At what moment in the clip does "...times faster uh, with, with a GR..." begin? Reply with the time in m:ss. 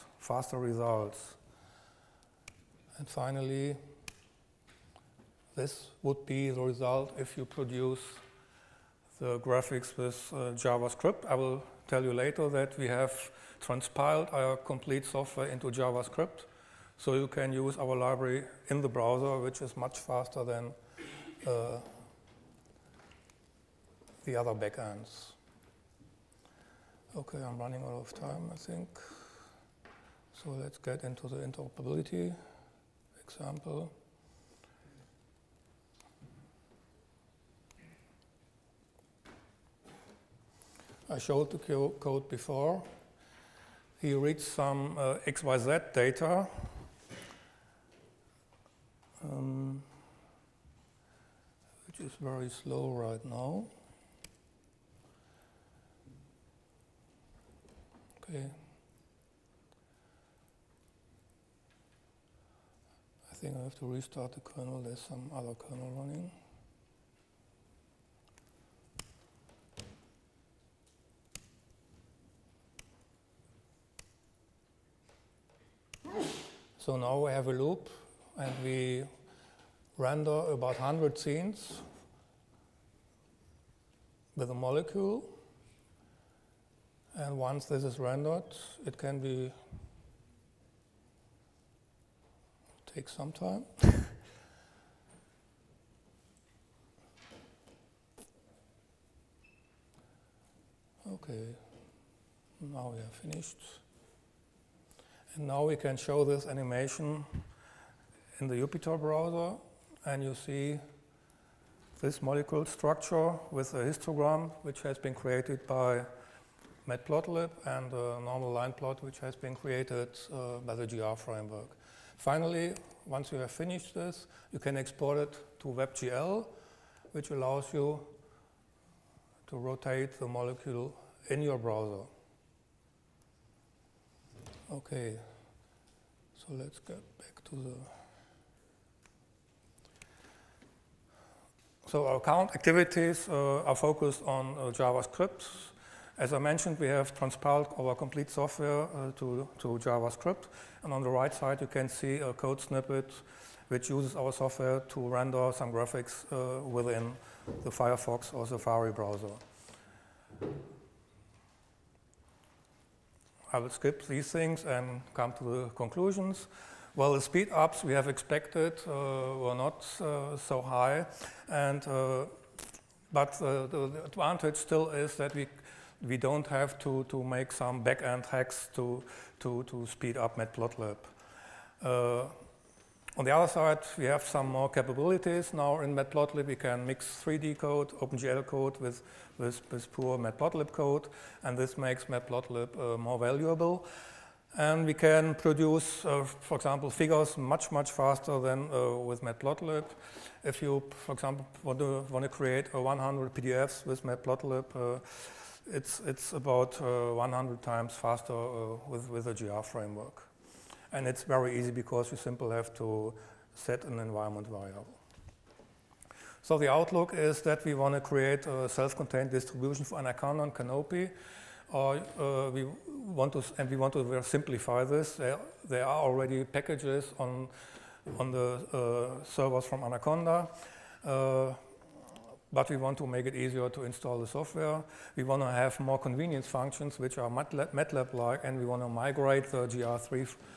3:27.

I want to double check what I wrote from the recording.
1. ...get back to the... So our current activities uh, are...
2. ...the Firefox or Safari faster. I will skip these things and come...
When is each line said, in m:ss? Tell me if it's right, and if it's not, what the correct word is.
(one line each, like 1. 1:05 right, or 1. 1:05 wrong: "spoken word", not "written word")
1. 2:16 right
2. 2:37 wrong: "browser", not "faster".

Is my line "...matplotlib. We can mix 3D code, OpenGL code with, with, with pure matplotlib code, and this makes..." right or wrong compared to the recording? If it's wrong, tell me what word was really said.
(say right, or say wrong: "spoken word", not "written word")
right.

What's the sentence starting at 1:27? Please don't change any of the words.
And once this is rendered, it can be take some time.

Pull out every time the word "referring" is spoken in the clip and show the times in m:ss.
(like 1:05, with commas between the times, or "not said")
not said.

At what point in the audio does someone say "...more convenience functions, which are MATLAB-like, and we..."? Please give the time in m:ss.
3:55.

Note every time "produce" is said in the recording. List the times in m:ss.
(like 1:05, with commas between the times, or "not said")
0:07, 3:15.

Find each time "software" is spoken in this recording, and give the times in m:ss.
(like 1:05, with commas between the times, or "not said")
0:15, 2:28, 2:34, 3:54.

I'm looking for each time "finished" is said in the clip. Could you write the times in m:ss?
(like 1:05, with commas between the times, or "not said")
1:43, 2:03.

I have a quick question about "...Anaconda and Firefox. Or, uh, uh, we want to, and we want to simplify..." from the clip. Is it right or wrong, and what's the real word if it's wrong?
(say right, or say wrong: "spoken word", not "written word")
wrong: "Canopy", not "Firefox".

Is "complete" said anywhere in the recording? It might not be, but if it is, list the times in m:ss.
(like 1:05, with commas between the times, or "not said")
0:14, 2:27.